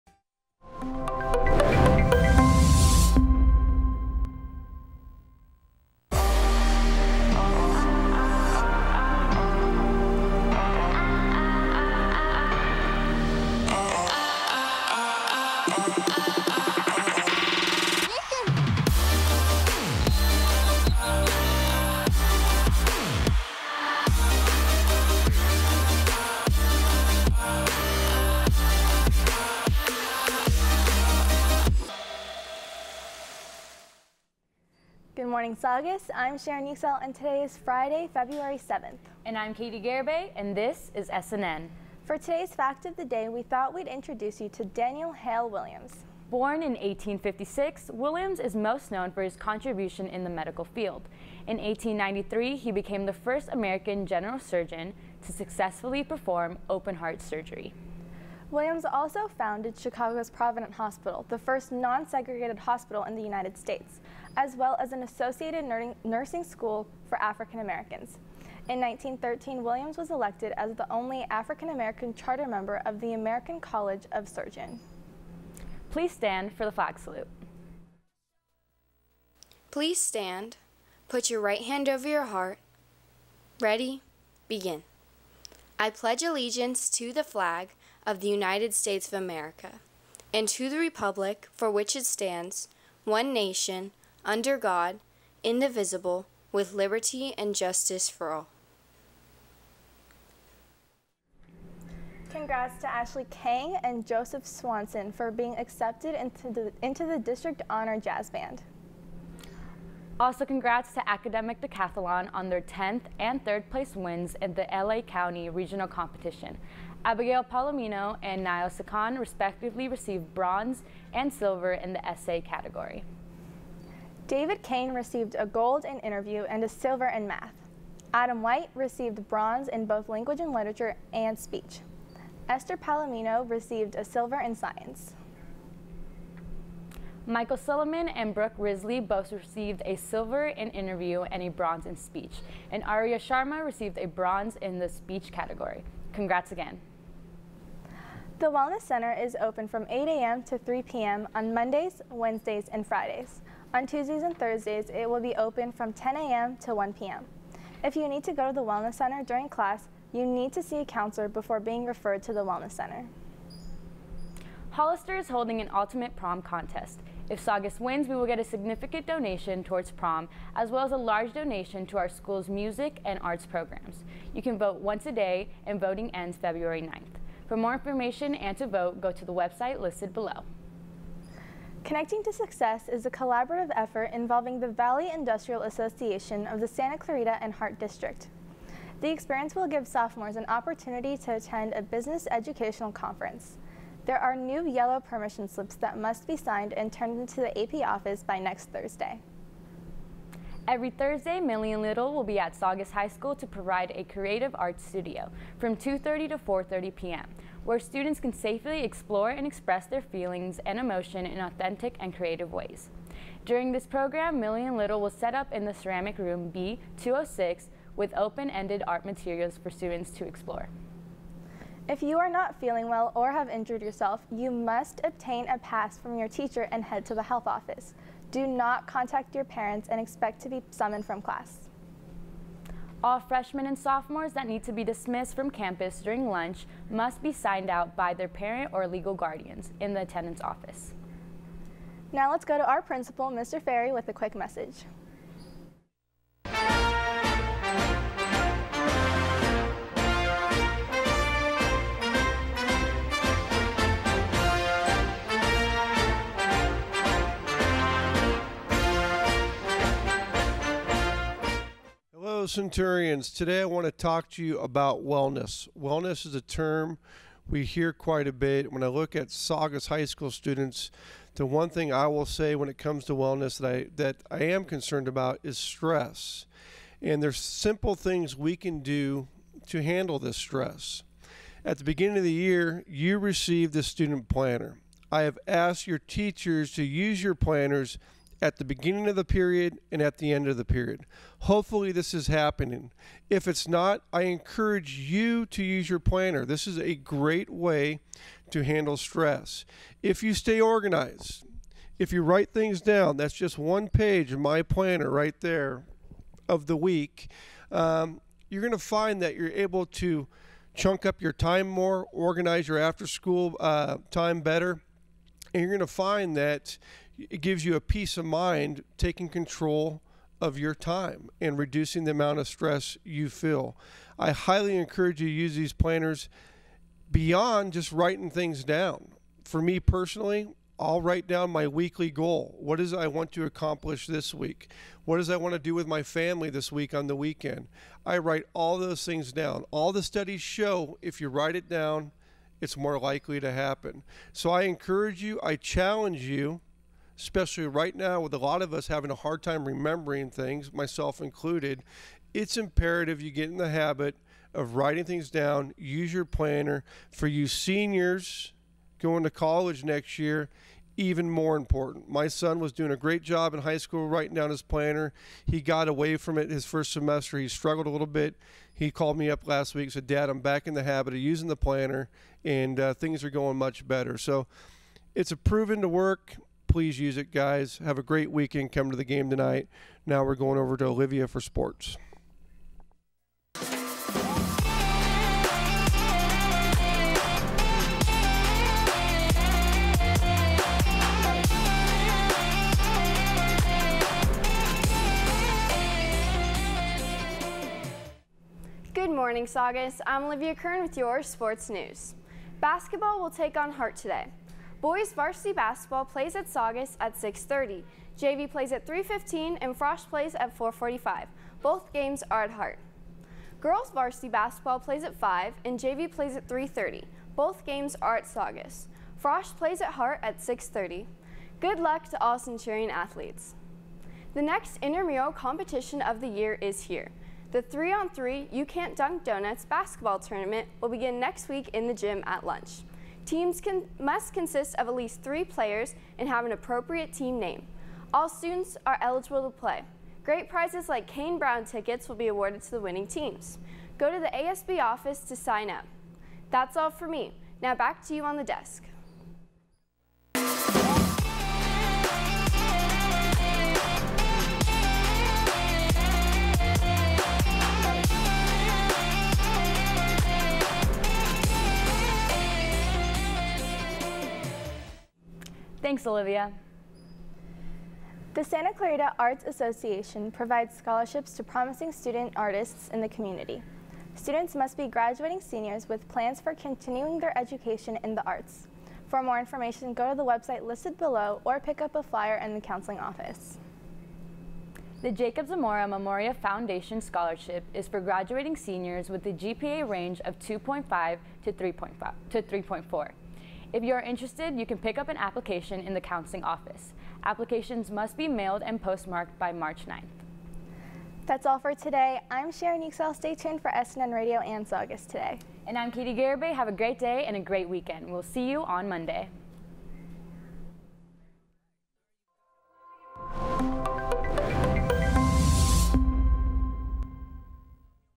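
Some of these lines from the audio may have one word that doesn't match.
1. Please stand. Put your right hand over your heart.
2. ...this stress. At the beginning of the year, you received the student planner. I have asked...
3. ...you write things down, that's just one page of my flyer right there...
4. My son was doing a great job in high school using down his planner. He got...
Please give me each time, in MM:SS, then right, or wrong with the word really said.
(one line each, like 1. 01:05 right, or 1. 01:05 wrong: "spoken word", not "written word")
1. 01:19 right
2. 04:40 right
3. 05:02 wrong: "planner", not "flyer"
4. 06:02 wrong: "writing", not "using".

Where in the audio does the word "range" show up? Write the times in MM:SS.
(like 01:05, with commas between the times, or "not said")
08:09.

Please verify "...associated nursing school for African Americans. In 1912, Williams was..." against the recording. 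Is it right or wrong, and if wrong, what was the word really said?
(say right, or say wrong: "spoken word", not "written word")
wrong: "1913", not "1912".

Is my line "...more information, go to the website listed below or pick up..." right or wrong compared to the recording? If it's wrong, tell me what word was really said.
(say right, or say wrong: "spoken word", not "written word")
right.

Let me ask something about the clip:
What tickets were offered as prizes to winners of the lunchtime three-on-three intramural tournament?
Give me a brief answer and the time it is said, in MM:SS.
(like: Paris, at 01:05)
Kane Brown tickets, at 07:21.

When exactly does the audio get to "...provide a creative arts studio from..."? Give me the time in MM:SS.
03:23.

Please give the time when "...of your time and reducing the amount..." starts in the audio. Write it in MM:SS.
05:20.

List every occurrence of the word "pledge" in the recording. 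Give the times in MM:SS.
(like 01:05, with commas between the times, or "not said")
01:25.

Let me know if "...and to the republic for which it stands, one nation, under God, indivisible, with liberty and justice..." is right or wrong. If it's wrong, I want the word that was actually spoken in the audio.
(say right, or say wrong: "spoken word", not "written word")
right.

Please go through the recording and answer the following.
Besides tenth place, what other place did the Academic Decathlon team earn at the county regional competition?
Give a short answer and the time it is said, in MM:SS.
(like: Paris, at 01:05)
3rd, at 01:53.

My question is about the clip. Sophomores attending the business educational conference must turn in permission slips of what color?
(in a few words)
Yellow.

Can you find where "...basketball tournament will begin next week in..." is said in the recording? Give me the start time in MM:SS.
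07:09.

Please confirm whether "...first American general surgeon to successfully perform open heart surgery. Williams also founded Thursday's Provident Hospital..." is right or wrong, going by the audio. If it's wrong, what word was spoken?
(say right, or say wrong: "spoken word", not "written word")
wrong: "Chicago", not "Thursday".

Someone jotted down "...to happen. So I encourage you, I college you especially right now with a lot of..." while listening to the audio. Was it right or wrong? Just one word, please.
wrong.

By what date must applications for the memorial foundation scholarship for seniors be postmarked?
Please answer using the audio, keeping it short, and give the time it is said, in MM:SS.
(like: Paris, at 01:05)
March 9, at 08:19.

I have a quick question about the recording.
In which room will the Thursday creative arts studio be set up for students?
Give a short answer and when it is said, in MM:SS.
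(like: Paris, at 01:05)
B206, at 03:36.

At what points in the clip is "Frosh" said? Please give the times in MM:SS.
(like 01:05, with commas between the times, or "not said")
06:49, 06:59.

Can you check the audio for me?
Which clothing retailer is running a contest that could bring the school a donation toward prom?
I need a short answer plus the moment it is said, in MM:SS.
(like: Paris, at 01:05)
Hollister, at 02:44.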